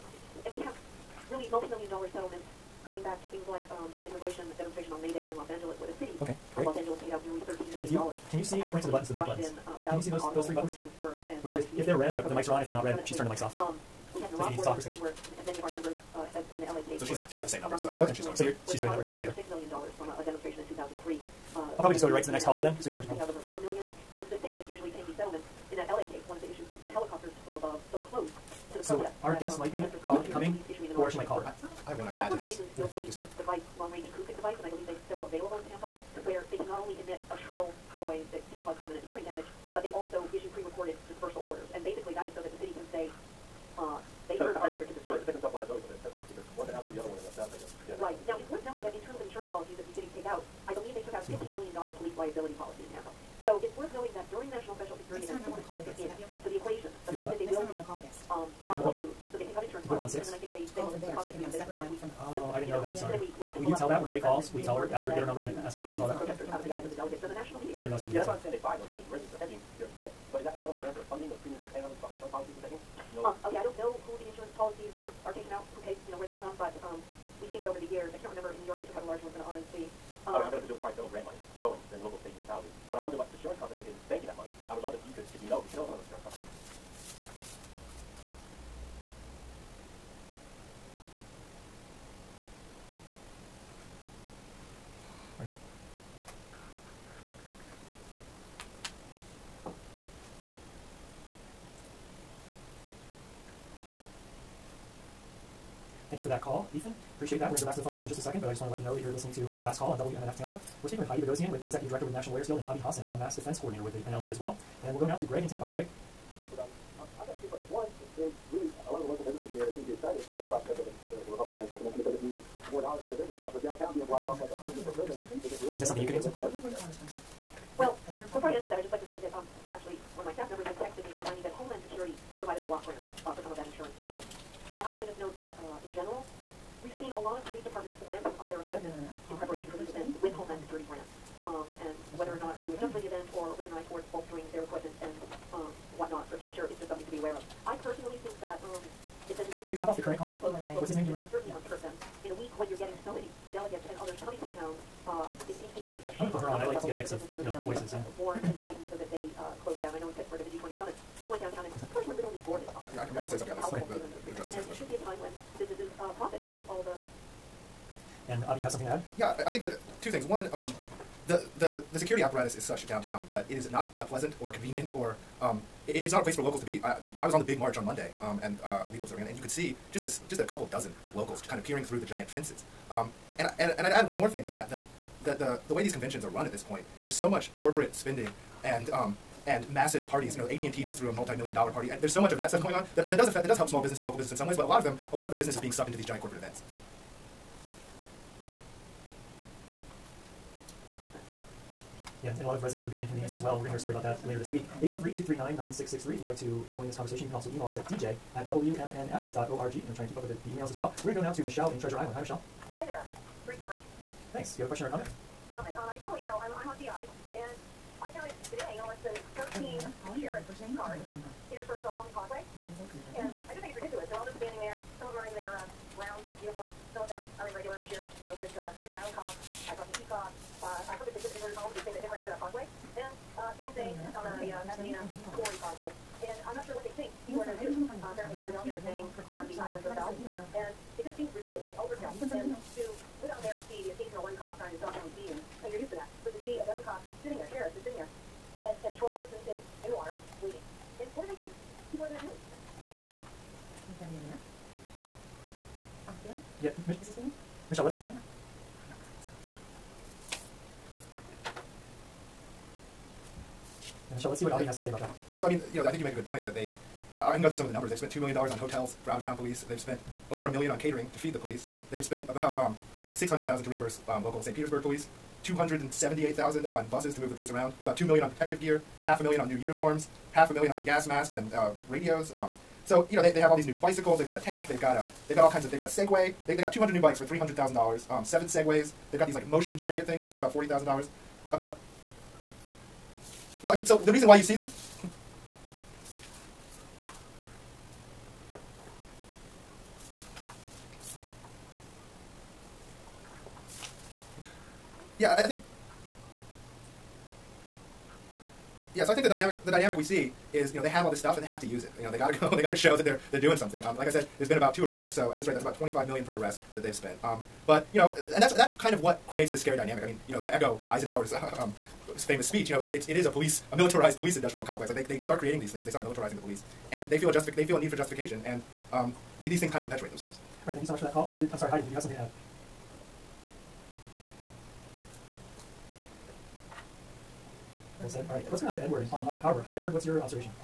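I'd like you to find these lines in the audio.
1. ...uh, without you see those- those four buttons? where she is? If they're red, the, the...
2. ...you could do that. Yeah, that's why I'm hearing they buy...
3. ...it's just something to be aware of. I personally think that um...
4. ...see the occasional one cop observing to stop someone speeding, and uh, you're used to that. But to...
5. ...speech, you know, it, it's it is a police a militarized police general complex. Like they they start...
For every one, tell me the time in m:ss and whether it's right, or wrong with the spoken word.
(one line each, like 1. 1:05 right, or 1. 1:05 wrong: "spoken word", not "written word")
1. 0:09 wrong: "three", not "four"
2. 1:08 wrong: "saying", not "hearing"
3. 2:26 right
4. 4:03 wrong: "trying", not "observing"
5. 5:22 wrong: "industrial", not "general".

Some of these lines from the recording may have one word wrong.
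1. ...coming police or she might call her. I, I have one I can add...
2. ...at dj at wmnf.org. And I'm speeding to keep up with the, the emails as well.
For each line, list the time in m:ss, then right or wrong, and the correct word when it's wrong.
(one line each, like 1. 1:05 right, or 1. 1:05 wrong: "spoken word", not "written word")
1. 0:30 right
2. 3:27 wrong: "trying", not "speeding".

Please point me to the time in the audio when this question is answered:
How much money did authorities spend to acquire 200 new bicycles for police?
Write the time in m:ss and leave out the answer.
4:47.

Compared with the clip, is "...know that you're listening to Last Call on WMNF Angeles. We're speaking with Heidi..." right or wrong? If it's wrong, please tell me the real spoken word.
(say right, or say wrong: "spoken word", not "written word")
wrong: "Tampa", not "Angeles".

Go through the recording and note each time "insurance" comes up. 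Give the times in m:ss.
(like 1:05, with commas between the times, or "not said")
2:13, 3:40.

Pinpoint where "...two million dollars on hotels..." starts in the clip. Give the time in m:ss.
4:28.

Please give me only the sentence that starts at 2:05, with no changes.
Is that something you could answer?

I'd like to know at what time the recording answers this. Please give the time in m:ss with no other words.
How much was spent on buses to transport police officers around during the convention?
4:35.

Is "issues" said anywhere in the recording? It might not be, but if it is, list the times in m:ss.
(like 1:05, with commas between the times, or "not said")
0:26, 0:40.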